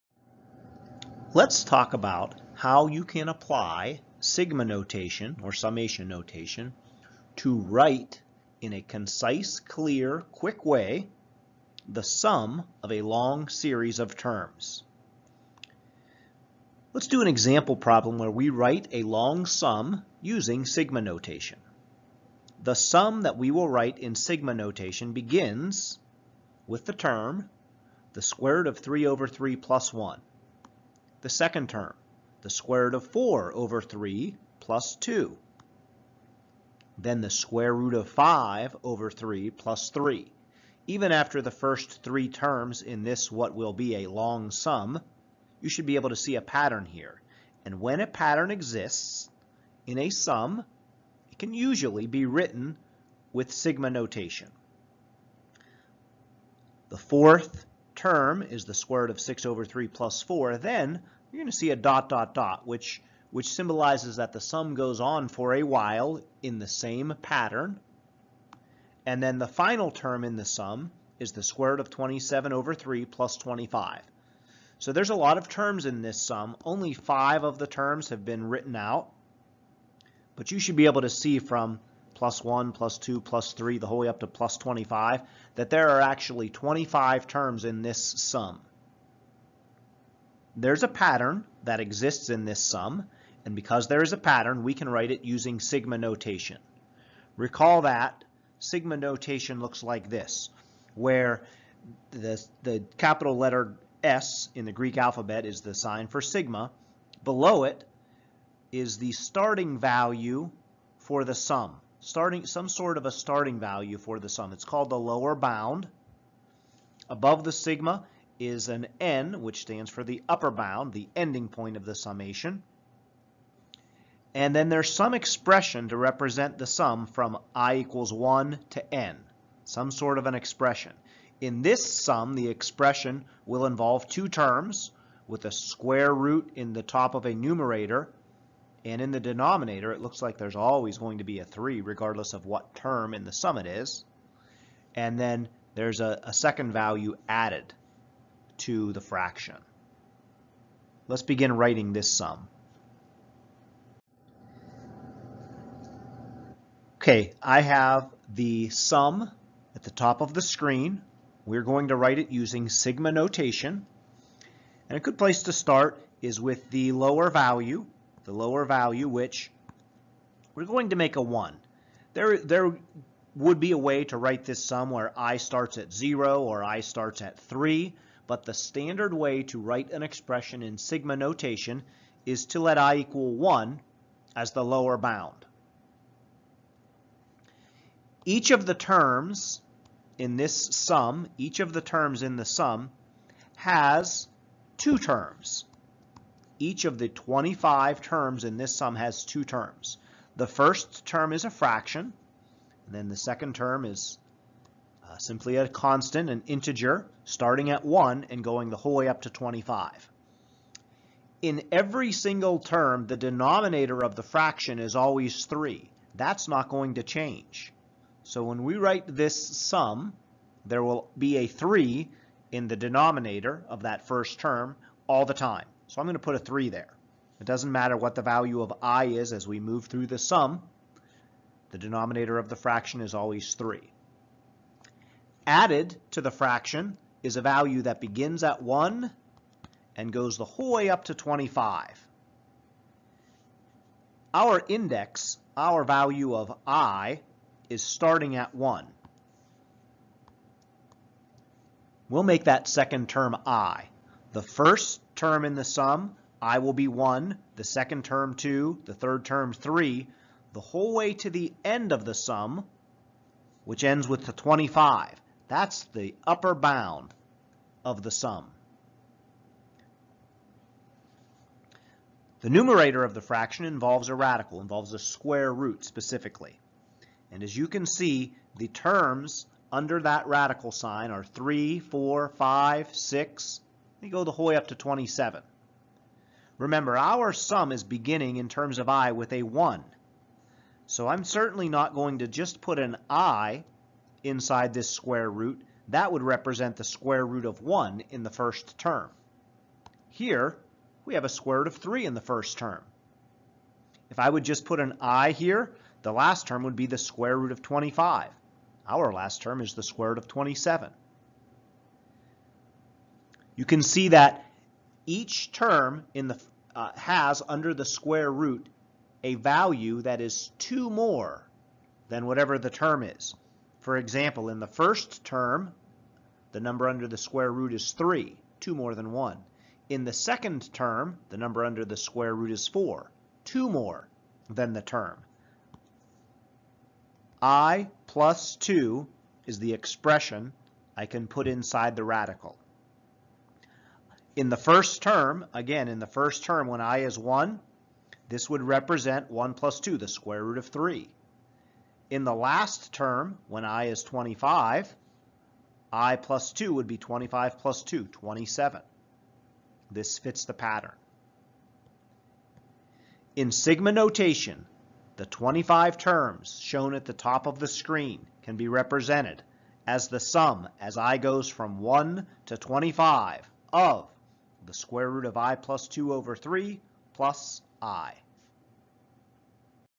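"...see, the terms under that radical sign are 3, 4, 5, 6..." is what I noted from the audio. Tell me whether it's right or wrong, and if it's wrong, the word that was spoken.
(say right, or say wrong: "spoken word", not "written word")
right.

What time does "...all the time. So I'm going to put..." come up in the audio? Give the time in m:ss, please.
3:45.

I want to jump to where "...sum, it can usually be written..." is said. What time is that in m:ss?
0:50.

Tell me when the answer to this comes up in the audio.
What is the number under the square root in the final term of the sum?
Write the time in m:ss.
5:08.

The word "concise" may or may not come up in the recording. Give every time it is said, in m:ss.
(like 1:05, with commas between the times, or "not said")
0:08.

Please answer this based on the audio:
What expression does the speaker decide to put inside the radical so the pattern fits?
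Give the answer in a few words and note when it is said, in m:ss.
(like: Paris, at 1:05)
i plus 2, at 5:37.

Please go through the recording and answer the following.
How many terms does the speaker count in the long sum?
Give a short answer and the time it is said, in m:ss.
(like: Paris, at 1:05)
25, at 1:25.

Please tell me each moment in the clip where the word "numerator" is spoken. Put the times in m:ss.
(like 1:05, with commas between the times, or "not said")
2:17, 4:32.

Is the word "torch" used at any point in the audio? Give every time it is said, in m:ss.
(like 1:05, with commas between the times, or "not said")
not said.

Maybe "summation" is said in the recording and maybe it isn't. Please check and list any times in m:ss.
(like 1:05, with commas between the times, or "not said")
0:05, 2:01.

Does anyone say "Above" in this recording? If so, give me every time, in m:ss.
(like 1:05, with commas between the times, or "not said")
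1:57.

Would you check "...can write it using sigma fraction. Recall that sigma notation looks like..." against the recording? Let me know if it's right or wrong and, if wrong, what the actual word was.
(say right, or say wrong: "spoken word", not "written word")
wrong: "notation", not "fraction".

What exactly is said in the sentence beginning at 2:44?
And a good place to start is with the lower value, the lower value, which we're going to make a 1.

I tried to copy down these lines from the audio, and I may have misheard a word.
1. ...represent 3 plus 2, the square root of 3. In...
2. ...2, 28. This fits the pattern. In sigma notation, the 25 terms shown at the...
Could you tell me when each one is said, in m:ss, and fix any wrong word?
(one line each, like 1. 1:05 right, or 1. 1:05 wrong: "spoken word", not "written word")
1. 5:48 wrong: "1", not "3"
2. 5:57 wrong: "27", not "28".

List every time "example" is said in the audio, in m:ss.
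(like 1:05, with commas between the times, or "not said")
0:17, 5:23.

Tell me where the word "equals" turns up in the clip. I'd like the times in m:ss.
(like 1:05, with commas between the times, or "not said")
2:07, 3:02.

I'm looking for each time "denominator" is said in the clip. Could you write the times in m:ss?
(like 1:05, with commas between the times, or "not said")
2:19, 3:33, 3:42, 3:51.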